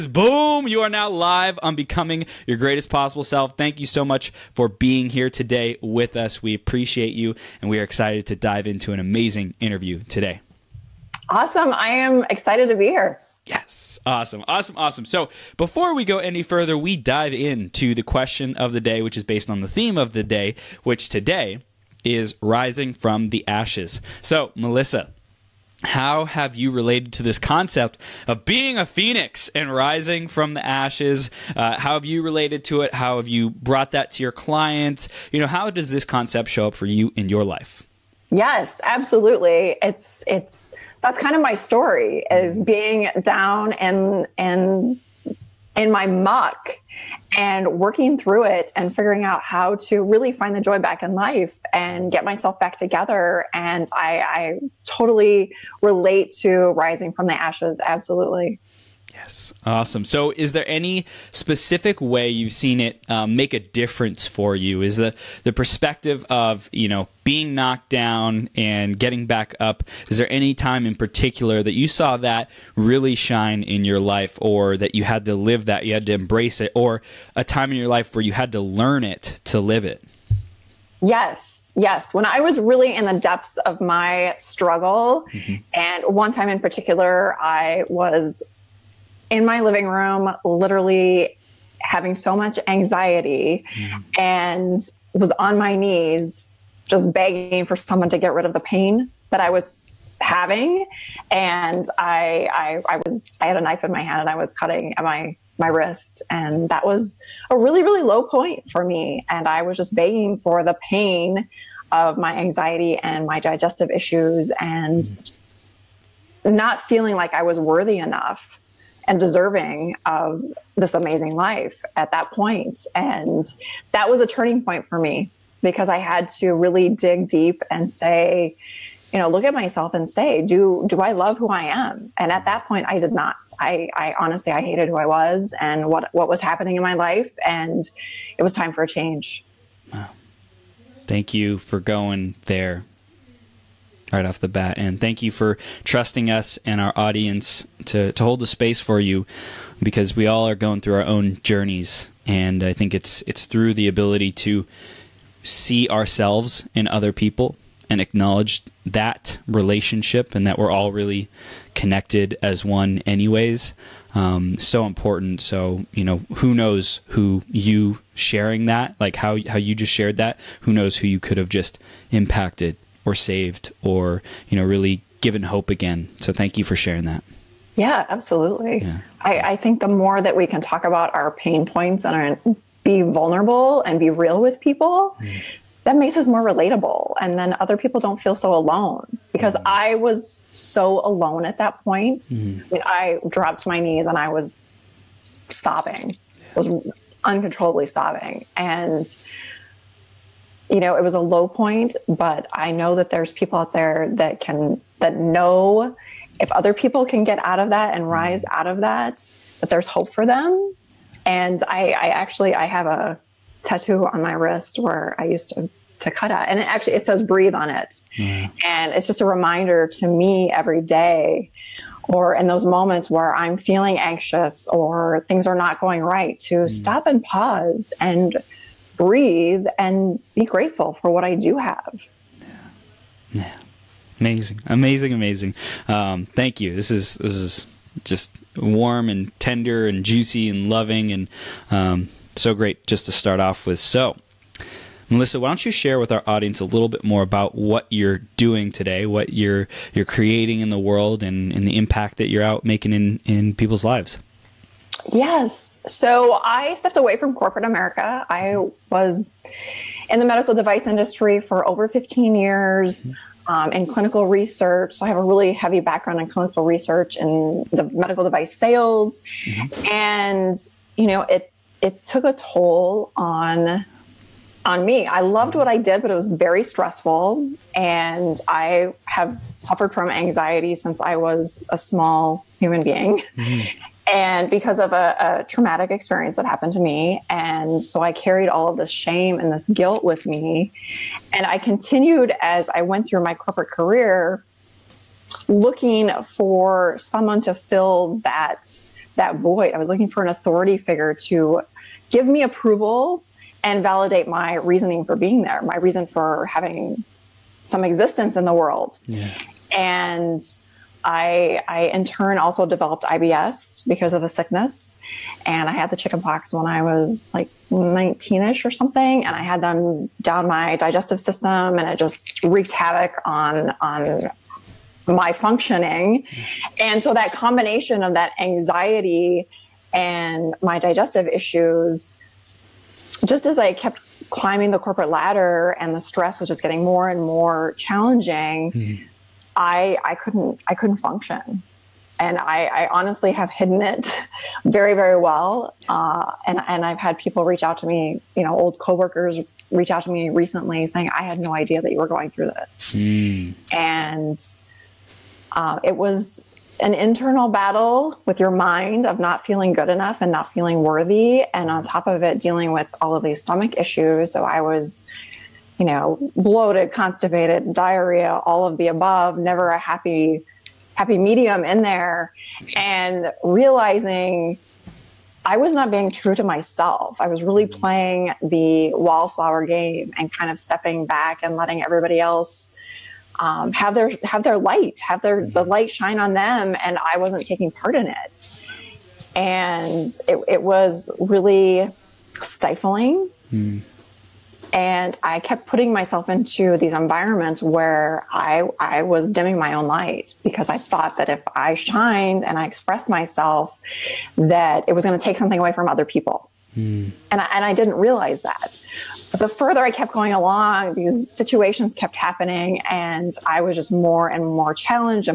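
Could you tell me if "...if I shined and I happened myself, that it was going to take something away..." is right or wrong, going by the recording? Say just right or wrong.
wrong.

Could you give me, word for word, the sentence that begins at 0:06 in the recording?
We appreciate you, and we are excited to dive into an amazing interview today.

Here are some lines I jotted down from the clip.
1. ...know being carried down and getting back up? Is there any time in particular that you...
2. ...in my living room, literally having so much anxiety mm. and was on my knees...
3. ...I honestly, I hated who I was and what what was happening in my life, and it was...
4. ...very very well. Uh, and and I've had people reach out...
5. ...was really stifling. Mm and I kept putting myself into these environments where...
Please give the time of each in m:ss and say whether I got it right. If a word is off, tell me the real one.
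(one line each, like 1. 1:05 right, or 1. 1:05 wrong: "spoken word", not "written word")
1. 1:06 wrong: "knocked", not "carried"
2. 1:29 right
3. 2:13 right
4. 5:44 right
5. 6:30 right.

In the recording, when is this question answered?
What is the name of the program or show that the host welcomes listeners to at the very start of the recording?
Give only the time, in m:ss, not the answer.
0:01.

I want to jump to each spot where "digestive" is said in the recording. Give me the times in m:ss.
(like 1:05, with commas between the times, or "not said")
1:53, 5:20, 5:30.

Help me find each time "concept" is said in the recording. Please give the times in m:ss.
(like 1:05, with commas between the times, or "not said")
0:27, 0:36.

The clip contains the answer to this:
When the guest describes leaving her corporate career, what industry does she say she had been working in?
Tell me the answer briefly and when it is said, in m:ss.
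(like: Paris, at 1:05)
Medical device industry, at 4:20.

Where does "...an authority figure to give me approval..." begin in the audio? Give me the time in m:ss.
5:00.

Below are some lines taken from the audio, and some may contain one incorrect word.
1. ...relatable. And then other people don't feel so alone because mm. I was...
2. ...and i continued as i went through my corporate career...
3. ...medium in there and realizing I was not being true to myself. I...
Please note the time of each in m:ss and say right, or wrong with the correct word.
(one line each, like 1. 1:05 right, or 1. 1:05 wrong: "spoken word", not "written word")
1. 3:06 right
2. 4:51 right
3. 6:11 right.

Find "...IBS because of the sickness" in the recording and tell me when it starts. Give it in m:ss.
5:13.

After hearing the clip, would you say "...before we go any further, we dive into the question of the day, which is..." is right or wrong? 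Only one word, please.
right.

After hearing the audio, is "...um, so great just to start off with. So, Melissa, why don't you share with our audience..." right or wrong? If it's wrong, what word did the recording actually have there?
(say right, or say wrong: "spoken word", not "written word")
right.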